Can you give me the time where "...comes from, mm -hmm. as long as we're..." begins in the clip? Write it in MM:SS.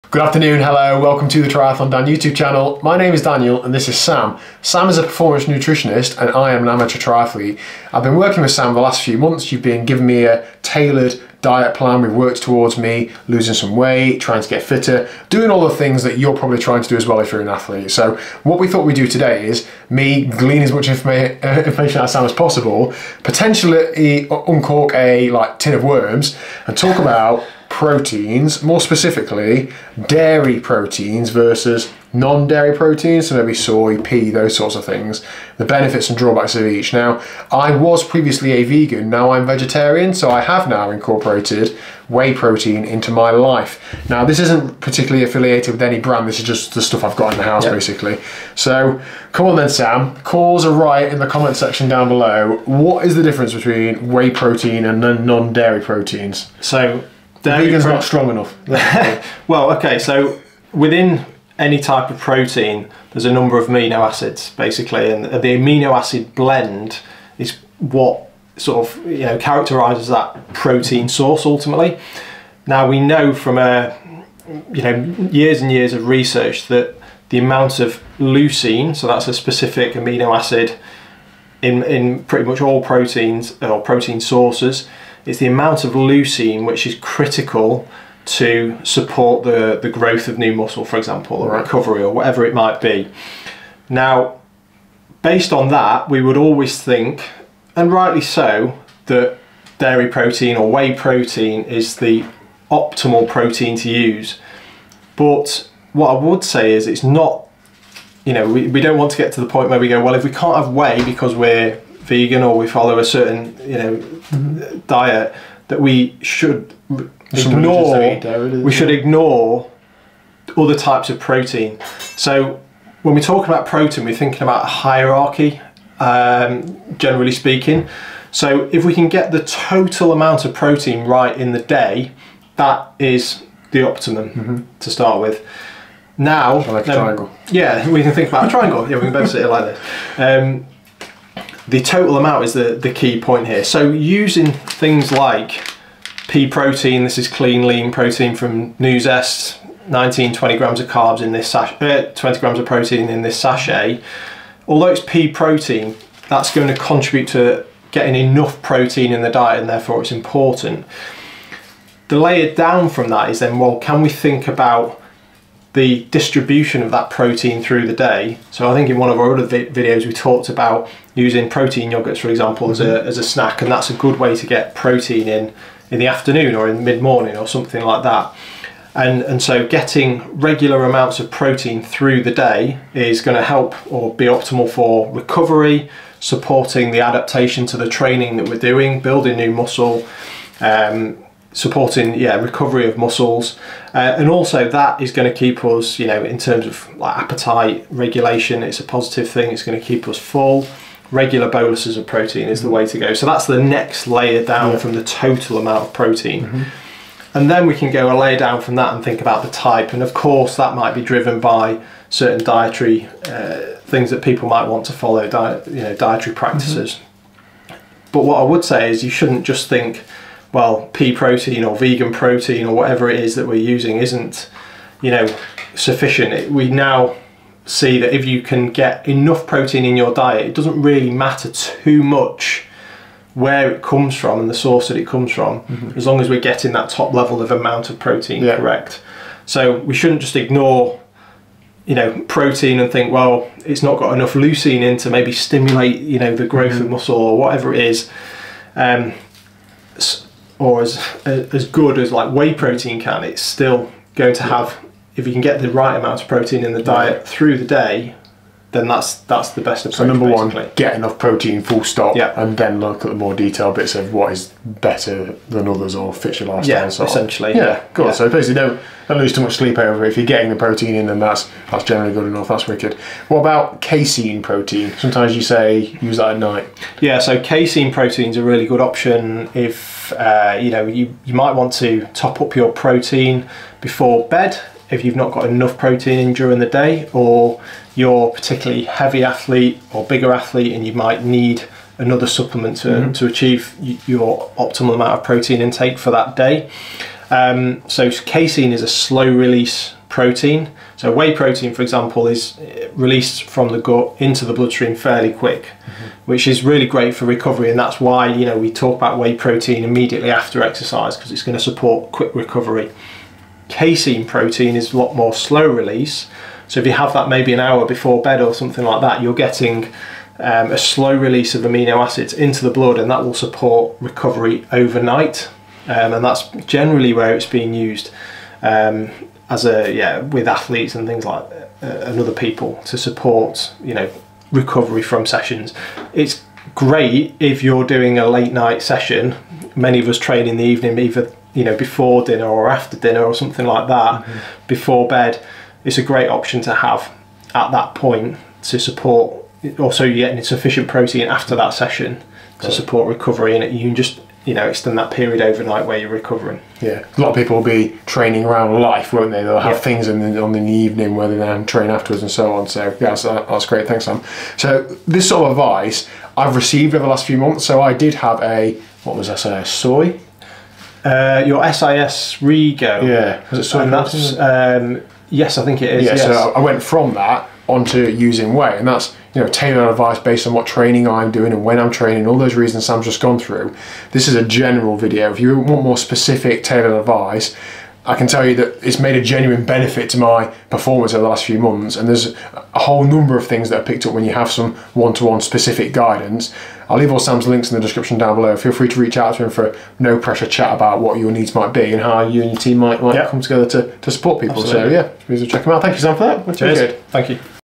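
03:55.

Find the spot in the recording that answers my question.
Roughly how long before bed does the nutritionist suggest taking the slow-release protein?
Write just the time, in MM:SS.
05:17.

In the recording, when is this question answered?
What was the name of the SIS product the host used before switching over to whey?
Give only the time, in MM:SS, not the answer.
06:12.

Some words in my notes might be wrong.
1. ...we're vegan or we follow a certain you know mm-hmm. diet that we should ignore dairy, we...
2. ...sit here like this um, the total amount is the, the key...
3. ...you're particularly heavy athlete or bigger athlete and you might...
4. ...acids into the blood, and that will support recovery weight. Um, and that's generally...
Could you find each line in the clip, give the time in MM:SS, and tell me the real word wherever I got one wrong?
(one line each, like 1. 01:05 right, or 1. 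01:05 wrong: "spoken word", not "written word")
1. 01:51 right
2. 02:19 right
3. 04:47 right
4. 05:21 wrong: "overnight", not "weight".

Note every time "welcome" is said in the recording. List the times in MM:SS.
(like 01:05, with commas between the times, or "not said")
00:00.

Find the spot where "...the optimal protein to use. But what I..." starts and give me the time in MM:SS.
01:41.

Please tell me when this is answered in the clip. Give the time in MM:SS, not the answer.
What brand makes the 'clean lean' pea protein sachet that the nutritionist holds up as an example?
02:28.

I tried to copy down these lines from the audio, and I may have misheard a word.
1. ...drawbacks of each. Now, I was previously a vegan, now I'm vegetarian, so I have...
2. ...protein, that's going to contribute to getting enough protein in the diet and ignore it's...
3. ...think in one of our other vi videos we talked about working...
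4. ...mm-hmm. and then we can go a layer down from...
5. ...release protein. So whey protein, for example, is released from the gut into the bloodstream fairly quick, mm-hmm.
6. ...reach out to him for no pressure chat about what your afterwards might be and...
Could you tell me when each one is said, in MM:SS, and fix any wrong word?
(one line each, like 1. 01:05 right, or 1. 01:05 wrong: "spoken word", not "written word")
1. 00:36 right
2. 02:35 wrong: "therefore", not "ignore"
3. 02:48 wrong: "using", not "working"
4. 03:26 right
5. 04:59 right
6. 06:38 wrong: "needs", not "afterwards".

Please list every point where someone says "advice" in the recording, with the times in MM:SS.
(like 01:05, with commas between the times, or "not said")
06:05, 06:19, 06:26.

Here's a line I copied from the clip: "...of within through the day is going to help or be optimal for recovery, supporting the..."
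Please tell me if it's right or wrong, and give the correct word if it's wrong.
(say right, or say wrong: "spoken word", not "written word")
wrong: "protein", not "within".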